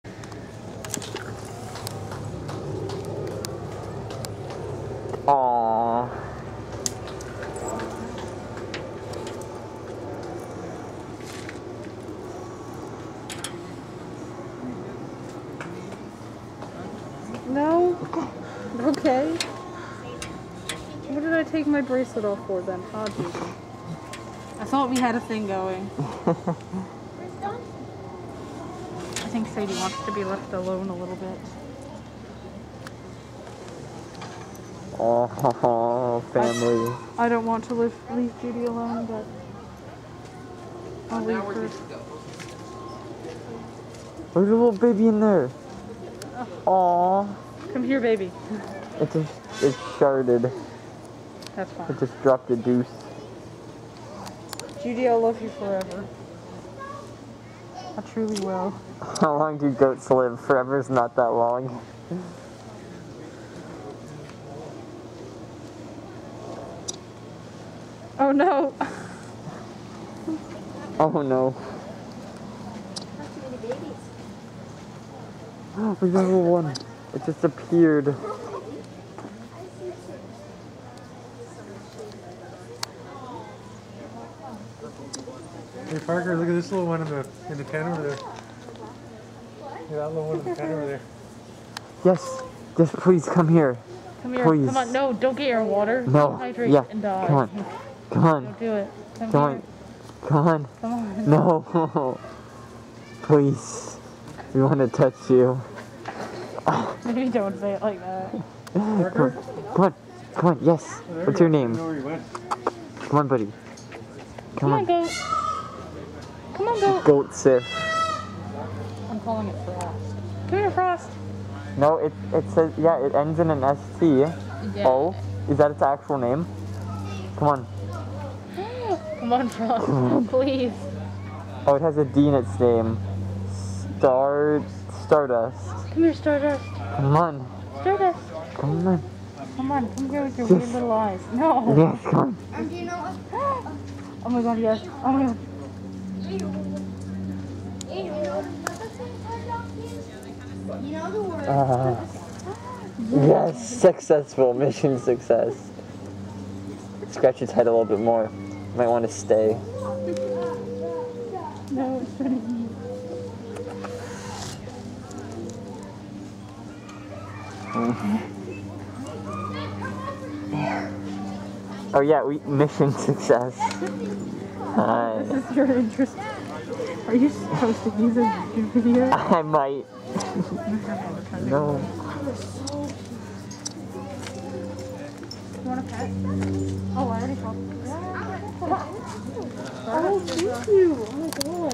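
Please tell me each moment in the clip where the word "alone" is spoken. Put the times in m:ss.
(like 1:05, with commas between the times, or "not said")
0:30, 0:38.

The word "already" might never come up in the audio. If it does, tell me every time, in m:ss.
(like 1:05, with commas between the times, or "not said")
3:06.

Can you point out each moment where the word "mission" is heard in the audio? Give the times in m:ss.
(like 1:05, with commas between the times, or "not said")
2:34, 2:52.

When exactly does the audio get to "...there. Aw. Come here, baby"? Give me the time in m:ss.
0:45.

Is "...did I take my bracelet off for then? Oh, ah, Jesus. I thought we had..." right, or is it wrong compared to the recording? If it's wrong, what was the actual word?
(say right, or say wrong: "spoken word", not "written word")
right.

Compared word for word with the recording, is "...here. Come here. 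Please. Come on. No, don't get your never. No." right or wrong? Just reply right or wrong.
wrong.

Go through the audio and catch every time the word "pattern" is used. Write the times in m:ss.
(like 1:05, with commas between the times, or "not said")
not said.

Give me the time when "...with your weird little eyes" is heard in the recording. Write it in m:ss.
2:20.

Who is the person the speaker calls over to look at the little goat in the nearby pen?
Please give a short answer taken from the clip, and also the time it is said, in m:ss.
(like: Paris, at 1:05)
Parker, at 1:25.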